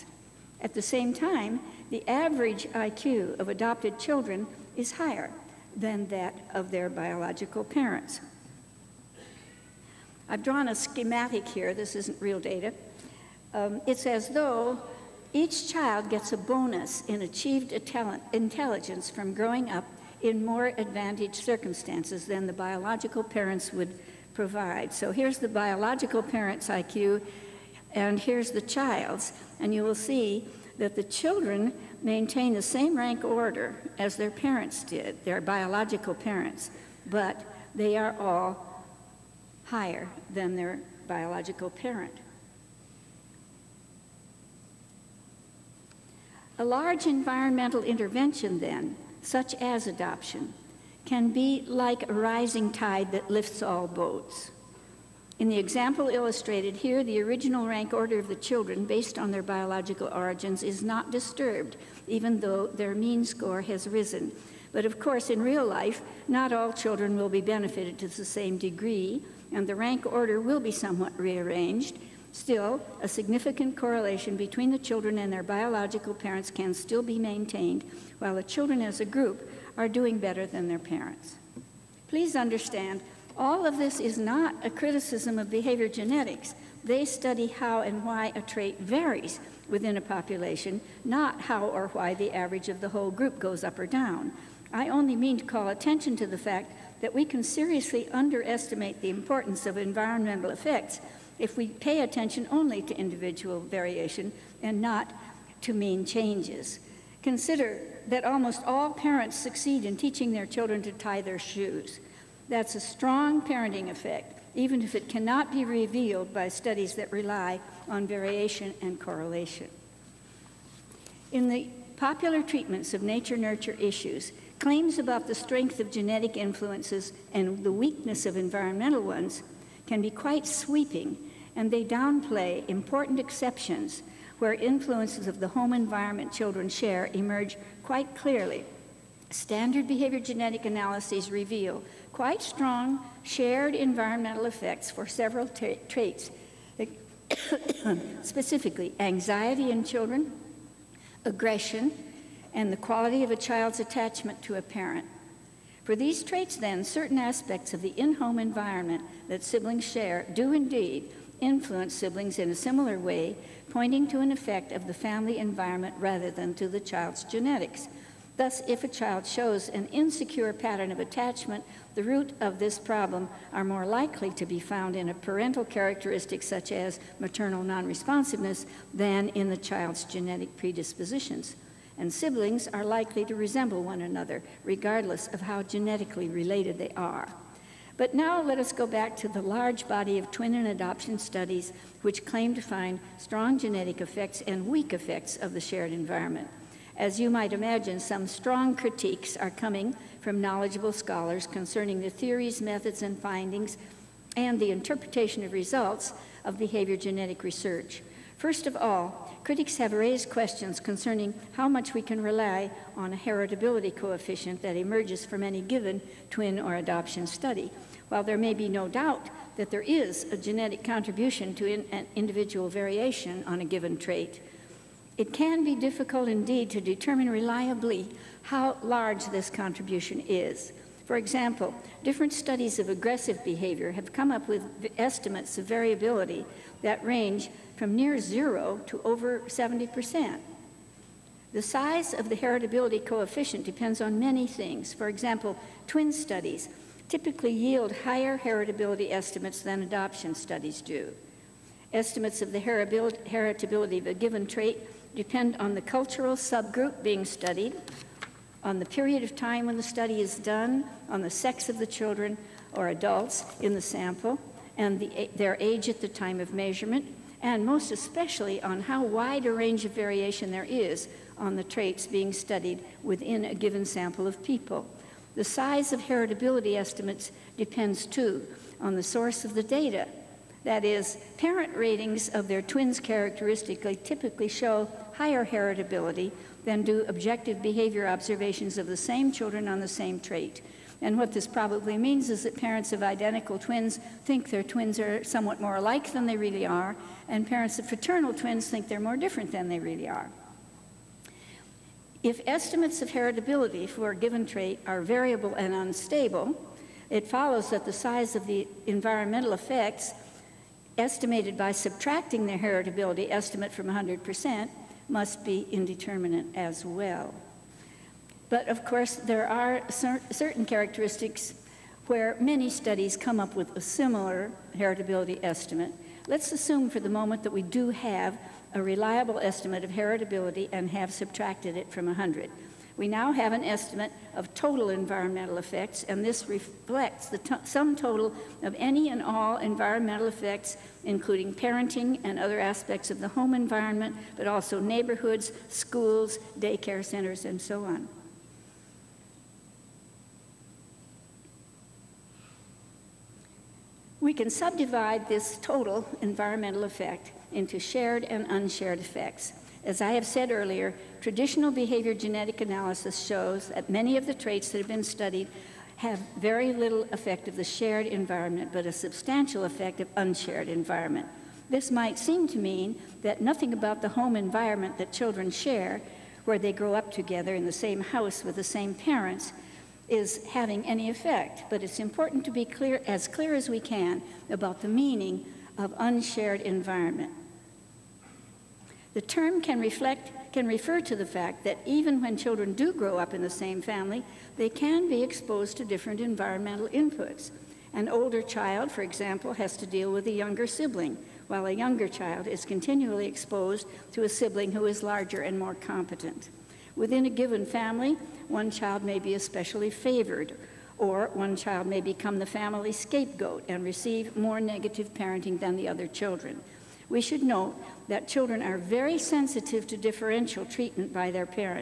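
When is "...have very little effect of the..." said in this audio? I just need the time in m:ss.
6:05.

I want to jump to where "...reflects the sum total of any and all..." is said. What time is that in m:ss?
5:36.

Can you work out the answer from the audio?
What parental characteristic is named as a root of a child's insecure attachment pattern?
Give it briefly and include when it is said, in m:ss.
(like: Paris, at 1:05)
maternal non-responsiveness, at 2:57.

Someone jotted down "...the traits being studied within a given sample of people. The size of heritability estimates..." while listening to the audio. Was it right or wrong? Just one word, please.
right.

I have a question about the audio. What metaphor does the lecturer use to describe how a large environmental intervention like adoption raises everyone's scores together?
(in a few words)
a rising tide that lifts all boats.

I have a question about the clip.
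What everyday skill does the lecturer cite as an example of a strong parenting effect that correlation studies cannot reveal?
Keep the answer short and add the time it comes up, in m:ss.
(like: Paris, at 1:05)
tie their shoes, at 1:50.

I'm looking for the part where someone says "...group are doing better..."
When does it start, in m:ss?
1:19.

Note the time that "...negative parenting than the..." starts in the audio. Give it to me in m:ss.
6:54.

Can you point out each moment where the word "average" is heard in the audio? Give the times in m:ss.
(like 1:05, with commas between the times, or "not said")
0:02, 1:32.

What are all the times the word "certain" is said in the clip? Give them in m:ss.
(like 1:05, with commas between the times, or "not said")
2:36, 5:20.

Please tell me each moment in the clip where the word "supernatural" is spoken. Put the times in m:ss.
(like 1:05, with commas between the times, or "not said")
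not said.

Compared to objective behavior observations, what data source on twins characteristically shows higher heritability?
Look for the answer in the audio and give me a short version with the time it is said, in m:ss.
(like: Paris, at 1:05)
parent ratings, at 4:41.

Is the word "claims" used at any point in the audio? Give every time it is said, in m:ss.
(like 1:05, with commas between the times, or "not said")
2:04, 3:12.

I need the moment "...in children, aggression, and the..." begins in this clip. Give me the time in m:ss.
2:29.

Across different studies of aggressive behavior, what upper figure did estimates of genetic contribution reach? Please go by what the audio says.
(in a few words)
over 70%.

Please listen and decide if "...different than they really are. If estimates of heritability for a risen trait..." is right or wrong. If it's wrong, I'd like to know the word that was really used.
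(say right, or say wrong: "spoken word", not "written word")
wrong: "given", not "risen".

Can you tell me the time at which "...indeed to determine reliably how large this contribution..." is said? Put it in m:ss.
3:46.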